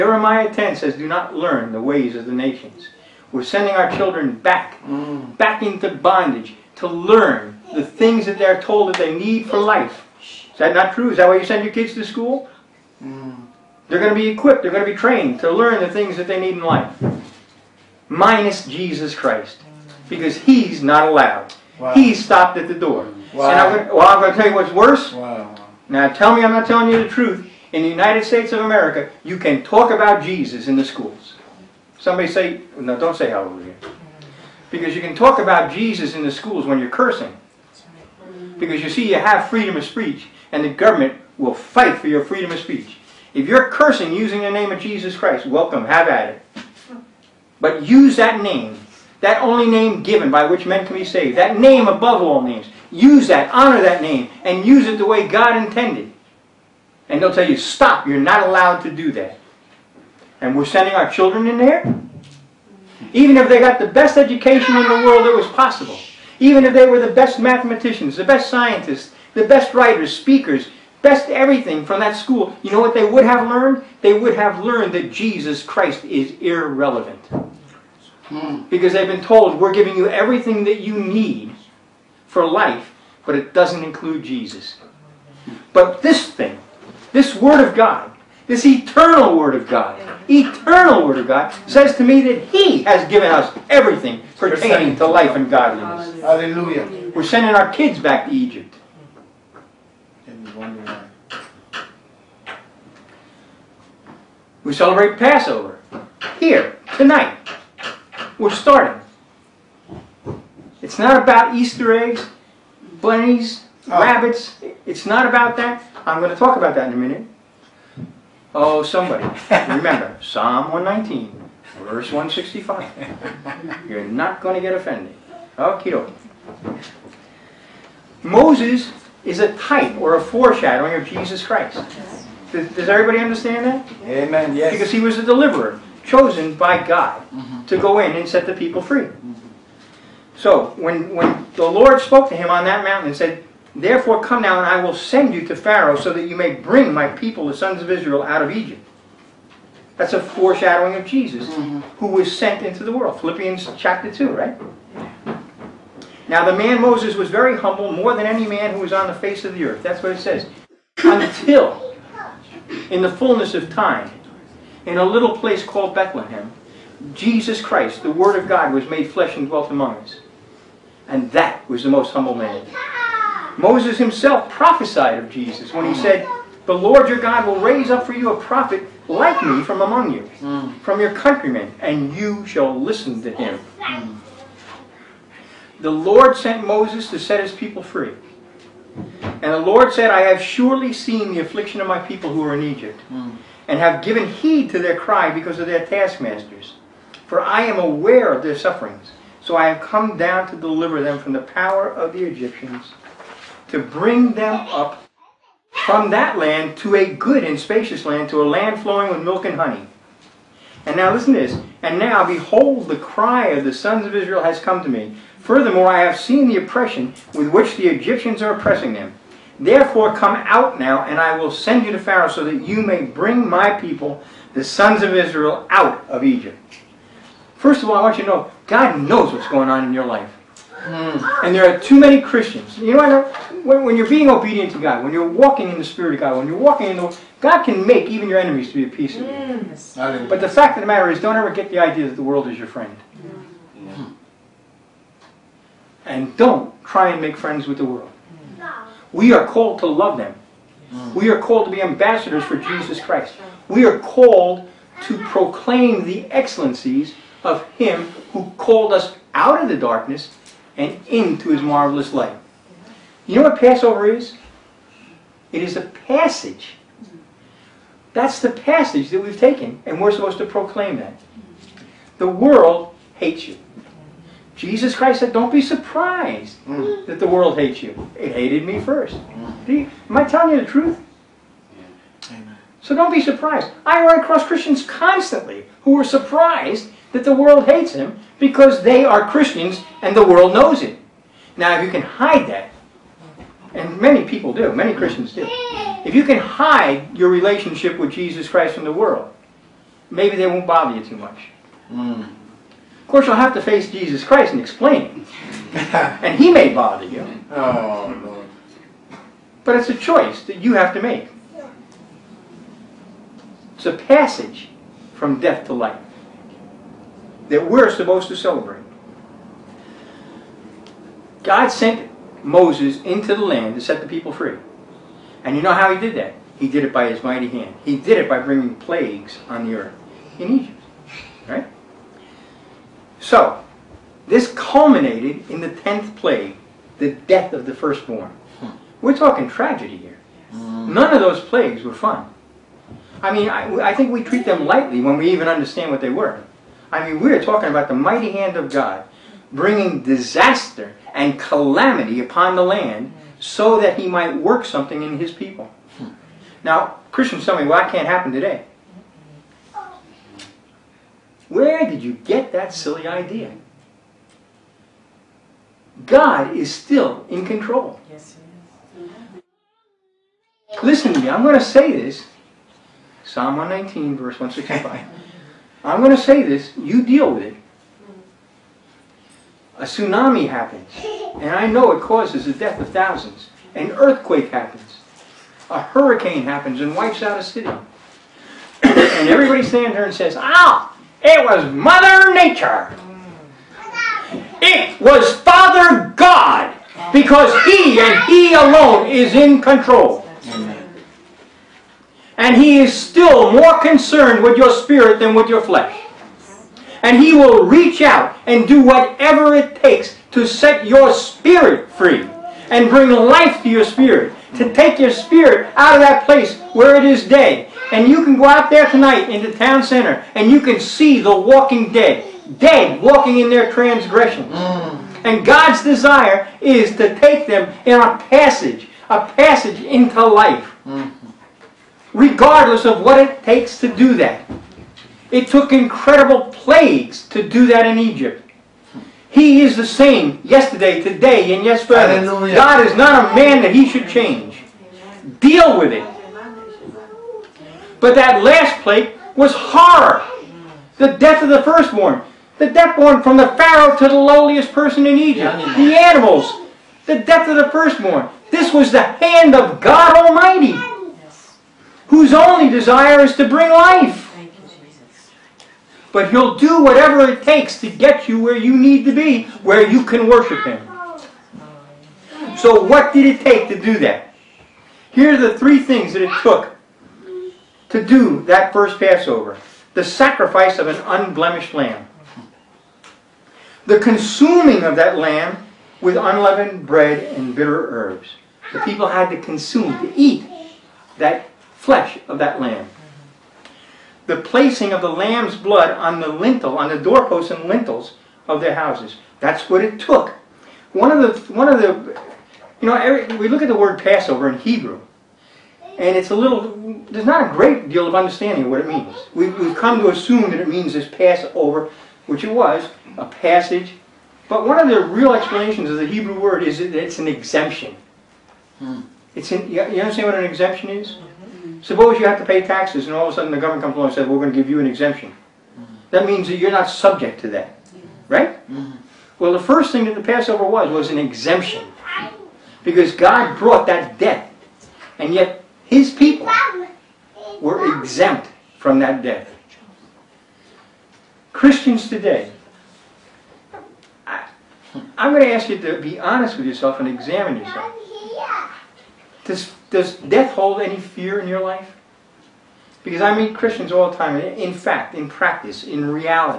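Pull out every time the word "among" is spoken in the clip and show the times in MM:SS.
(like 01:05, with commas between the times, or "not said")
02:49, 02:59.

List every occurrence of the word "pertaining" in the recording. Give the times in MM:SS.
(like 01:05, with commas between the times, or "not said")
01:34.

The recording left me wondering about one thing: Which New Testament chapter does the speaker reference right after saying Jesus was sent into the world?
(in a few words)
Philippians chapter 2.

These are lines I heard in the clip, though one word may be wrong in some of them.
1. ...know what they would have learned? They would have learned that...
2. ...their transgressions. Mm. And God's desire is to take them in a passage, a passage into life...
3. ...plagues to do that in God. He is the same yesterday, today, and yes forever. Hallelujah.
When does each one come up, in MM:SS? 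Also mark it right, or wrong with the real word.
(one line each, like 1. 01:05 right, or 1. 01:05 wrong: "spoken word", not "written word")
1. 01:12 right
2. 07:03 right
3. 07:16 wrong: "Egypt", not "God".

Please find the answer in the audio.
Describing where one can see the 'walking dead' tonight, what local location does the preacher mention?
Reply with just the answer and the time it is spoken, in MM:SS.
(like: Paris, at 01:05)
town center, at 06:59.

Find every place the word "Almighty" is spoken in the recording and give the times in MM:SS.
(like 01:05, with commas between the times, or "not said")
07:40.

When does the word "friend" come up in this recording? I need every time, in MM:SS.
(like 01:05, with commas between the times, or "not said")
04:02, 04:07.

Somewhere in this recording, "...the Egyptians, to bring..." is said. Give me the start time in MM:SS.
03:22.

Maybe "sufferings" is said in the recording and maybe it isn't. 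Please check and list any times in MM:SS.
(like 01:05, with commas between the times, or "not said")
03:18.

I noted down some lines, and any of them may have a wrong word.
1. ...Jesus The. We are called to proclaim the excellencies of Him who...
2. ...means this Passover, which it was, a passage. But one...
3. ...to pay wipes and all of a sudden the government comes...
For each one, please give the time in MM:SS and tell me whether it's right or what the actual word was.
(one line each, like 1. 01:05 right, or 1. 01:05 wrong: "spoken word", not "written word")
1. 04:12 wrong: "Christ", not "The"
2. 08:30 right
3. 08:42 wrong: "taxes", not "wipes".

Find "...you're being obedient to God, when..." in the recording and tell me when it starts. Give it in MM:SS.
03:53.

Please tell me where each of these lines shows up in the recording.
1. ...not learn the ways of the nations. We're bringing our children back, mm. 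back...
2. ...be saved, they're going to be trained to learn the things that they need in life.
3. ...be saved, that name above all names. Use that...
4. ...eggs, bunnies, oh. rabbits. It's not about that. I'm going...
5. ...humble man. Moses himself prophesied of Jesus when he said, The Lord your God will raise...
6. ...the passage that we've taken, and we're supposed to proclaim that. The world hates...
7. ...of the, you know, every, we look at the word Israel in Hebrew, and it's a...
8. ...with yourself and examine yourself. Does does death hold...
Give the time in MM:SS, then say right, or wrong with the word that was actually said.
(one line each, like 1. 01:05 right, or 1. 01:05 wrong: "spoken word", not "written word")
1. 00:01 wrong: "sending", not "bringing"
2. 00:14 wrong: "equipped", not "saved"
3. 00:50 right
4. 01:51 right
5. 02:52 right
6. 04:28 right
7. 08:21 wrong: "Passover", not "Israel"
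8. 09:06 right.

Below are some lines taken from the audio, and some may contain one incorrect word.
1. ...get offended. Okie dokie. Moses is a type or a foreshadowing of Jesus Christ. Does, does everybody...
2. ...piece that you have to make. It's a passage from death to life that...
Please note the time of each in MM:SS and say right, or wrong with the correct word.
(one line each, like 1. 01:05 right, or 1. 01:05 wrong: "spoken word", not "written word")
1. 02:04 right
2. 05:09 wrong: "choice", not "piece".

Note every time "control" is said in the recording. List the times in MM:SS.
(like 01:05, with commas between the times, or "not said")
06:07, 06:39.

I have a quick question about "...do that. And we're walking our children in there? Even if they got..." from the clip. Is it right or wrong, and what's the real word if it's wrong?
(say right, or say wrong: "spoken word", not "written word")
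wrong: "sending", not "walking".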